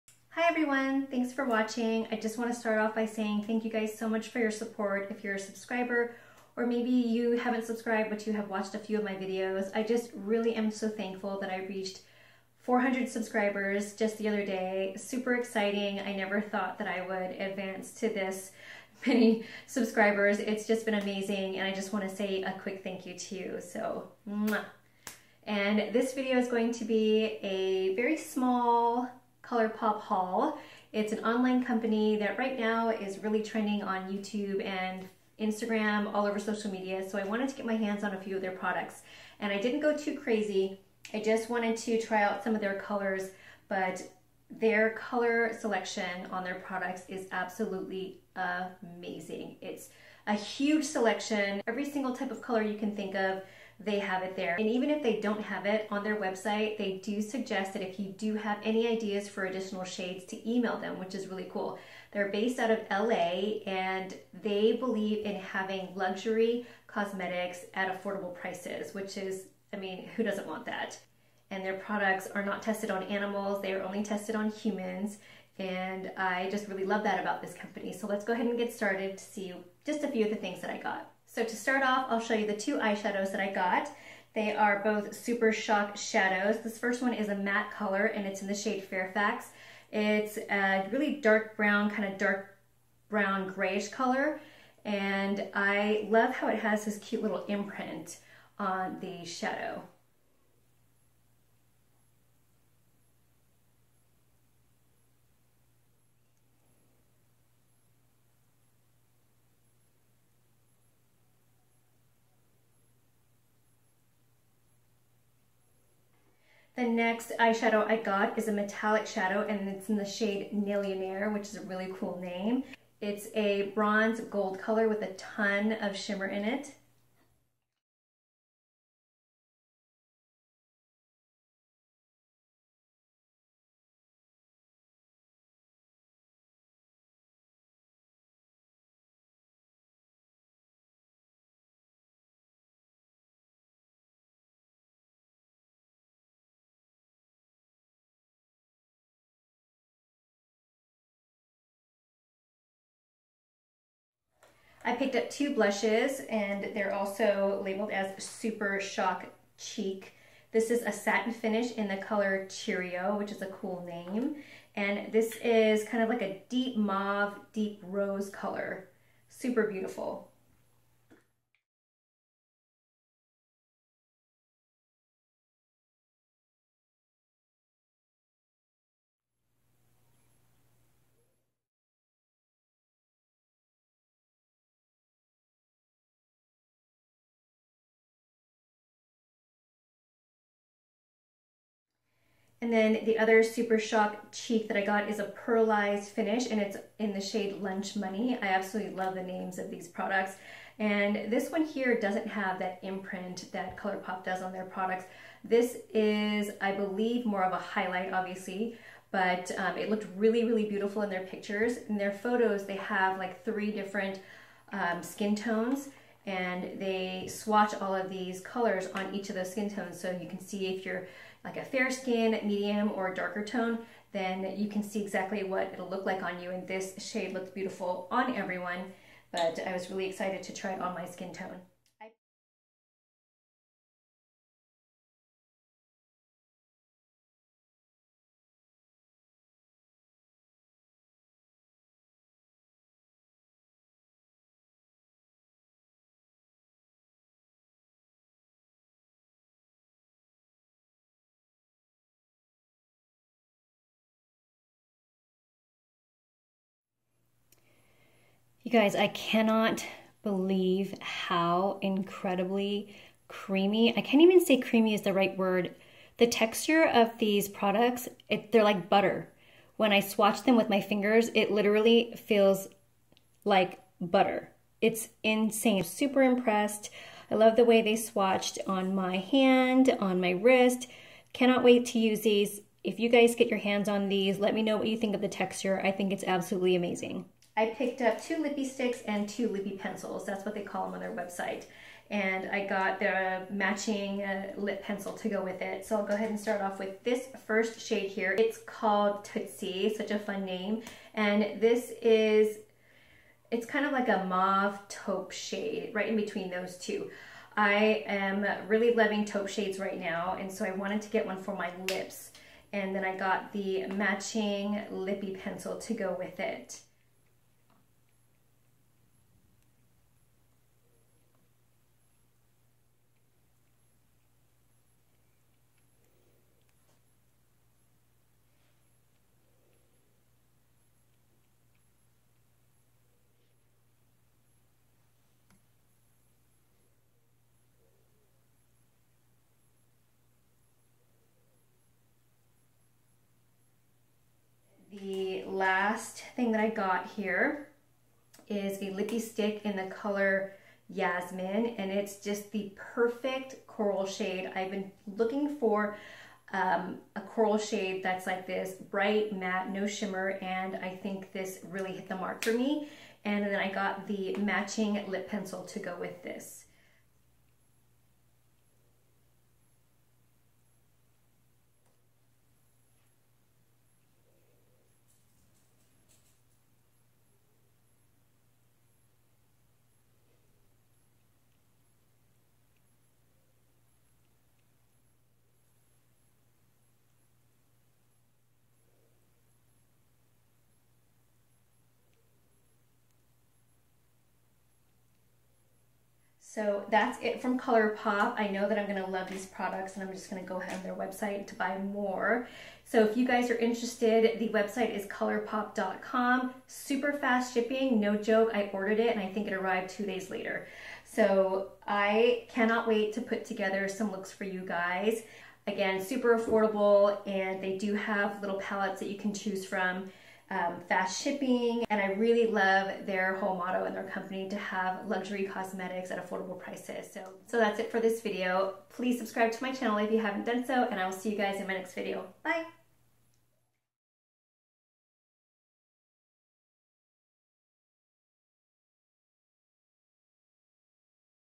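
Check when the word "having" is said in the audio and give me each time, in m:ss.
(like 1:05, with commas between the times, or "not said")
1:05.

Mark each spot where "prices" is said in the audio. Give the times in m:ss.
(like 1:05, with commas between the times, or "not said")
1:08, 7:06.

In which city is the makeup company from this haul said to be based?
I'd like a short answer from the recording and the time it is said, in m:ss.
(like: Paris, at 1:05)
LA, at 1:02.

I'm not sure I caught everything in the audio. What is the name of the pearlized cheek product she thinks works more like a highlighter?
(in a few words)
Lunch Money.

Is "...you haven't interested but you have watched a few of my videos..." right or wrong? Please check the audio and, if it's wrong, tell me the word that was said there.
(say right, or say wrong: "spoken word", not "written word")
wrong: "subscribed", not "interested".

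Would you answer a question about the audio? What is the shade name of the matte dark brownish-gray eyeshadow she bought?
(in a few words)
Fairfax.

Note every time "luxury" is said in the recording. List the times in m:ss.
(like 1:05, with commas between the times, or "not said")
1:05, 7:05.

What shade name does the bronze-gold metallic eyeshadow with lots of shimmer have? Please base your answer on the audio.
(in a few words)
Millionaire.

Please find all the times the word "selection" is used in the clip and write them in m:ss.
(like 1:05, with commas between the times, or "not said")
0:45, 0:50.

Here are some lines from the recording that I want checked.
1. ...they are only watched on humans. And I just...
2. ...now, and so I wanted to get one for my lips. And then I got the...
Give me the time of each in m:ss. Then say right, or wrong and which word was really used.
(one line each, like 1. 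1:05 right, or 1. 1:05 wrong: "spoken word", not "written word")
1. 1:13 wrong: "tested", not "watched"
2. 5:09 right.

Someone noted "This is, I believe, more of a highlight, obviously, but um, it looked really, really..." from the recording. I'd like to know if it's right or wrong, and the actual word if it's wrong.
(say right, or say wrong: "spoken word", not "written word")
right.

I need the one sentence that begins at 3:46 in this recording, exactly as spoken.
And this shade looked beautiful on everyone, but I was really excited to try it on my skin tone.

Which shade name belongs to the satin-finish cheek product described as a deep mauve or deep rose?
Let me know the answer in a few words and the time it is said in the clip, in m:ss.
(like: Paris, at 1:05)
Cheerio, at 2:42.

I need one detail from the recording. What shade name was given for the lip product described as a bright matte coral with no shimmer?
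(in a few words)
Yasmin.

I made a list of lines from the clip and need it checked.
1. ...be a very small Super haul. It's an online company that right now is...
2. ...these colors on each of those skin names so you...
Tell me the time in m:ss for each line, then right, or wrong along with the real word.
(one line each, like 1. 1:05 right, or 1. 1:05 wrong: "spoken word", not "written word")
1. 0:26 wrong: "ColourPop", not "Super"
2. 3:38 wrong: "tones", not "names".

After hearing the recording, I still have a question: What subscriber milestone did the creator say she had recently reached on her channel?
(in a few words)
400.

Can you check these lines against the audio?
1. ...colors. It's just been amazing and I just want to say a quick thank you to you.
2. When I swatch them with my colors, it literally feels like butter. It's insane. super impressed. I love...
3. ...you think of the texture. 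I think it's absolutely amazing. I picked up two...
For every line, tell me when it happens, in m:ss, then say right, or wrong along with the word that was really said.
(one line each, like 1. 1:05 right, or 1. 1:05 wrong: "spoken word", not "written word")
1. 0:19 wrong: "subscribers", not "colors"
2. 4:29 wrong: "fingers", not "colors"
3. 4:44 right.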